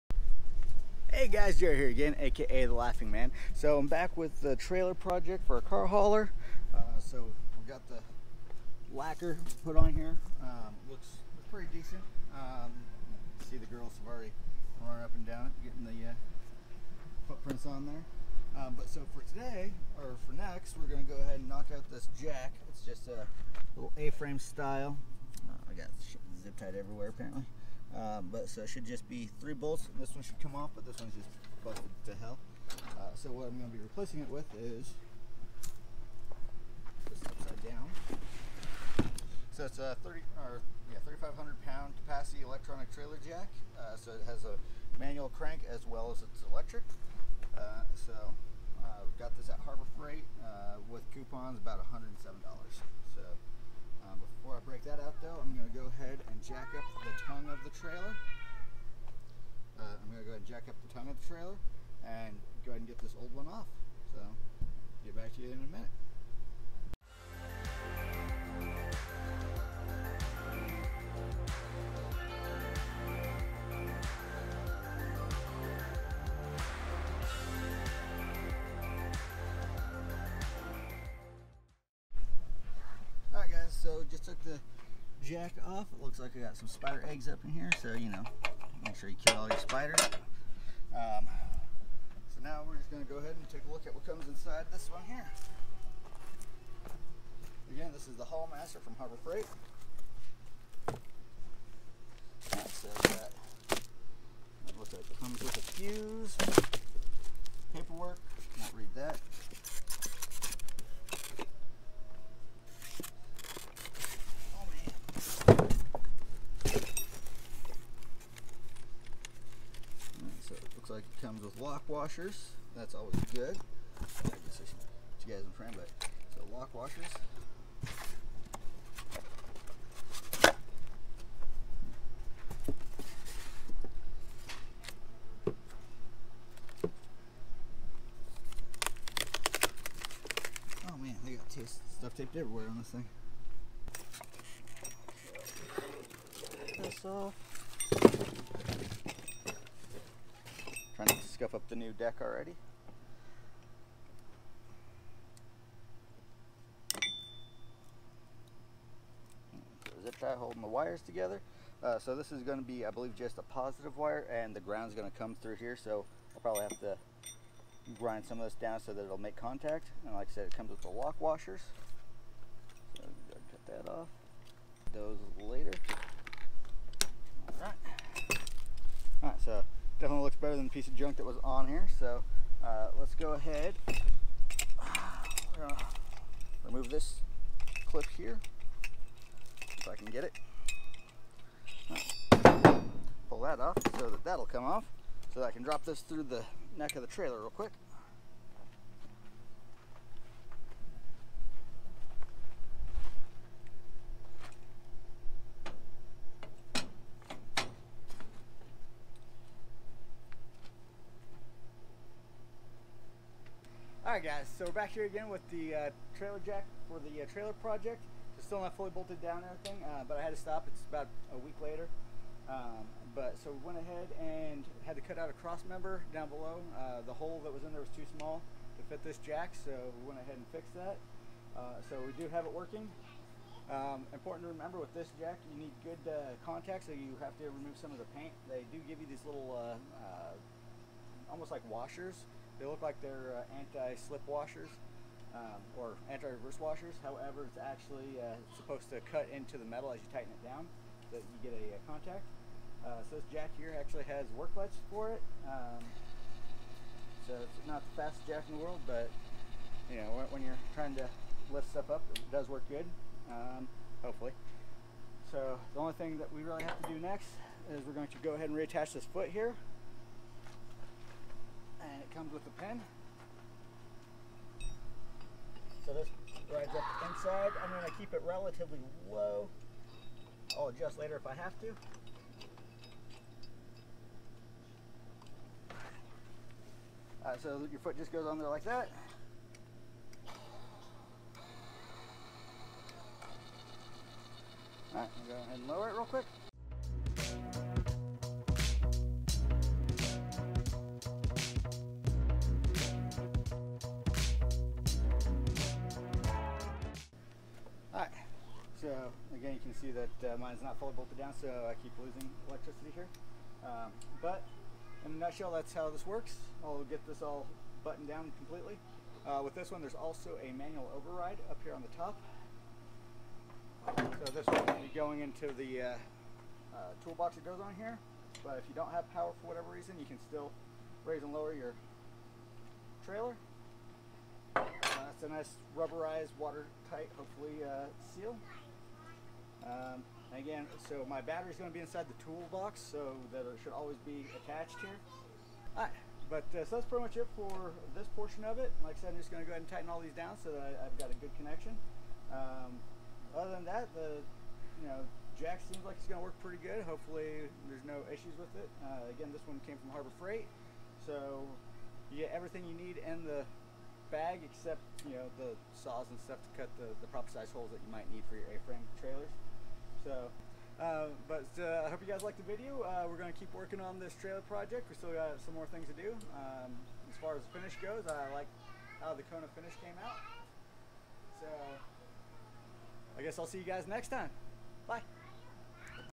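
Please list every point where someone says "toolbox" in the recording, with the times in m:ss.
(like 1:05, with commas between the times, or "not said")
5:27, 5:42.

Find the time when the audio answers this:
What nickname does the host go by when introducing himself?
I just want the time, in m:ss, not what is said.
0:02.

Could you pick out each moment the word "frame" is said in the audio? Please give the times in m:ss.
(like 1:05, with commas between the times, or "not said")
0:23, 2:05, 6:08.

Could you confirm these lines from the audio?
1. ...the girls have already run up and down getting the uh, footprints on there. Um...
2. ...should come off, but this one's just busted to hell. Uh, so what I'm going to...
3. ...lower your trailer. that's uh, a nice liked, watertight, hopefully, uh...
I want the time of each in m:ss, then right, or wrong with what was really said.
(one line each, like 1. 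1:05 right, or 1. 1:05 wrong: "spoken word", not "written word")
1. 0:13 right
2. 0:30 right
3. 5:31 wrong: "rubberized", not "liked".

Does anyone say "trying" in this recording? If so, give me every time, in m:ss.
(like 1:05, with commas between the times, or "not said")
2:31, 4:20.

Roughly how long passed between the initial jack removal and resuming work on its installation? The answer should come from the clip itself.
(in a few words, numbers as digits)
a week.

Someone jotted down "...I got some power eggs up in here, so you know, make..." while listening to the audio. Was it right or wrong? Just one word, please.
wrong.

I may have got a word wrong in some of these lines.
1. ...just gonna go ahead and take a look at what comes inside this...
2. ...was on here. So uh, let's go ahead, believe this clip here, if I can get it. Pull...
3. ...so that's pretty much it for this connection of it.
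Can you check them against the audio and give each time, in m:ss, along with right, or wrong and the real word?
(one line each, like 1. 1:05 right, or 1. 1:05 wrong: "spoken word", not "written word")
1. 1:32 right
2. 3:01 wrong: "remove", not "believe"
3. 5:46 wrong: "portion", not "connection".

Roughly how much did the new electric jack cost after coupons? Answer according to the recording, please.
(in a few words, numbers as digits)
$107.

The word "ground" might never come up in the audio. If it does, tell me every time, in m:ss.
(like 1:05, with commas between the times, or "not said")
2:44.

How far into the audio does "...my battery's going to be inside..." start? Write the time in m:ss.
5:41.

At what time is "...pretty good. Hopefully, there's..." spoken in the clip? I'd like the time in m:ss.
5:56.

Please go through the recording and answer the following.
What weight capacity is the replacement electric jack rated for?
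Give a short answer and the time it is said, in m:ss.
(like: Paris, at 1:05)
3,500 pounds, at 0:41.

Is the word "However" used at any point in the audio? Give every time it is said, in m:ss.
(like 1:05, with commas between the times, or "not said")
4:07.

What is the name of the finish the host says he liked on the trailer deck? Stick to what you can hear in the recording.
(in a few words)
Kona.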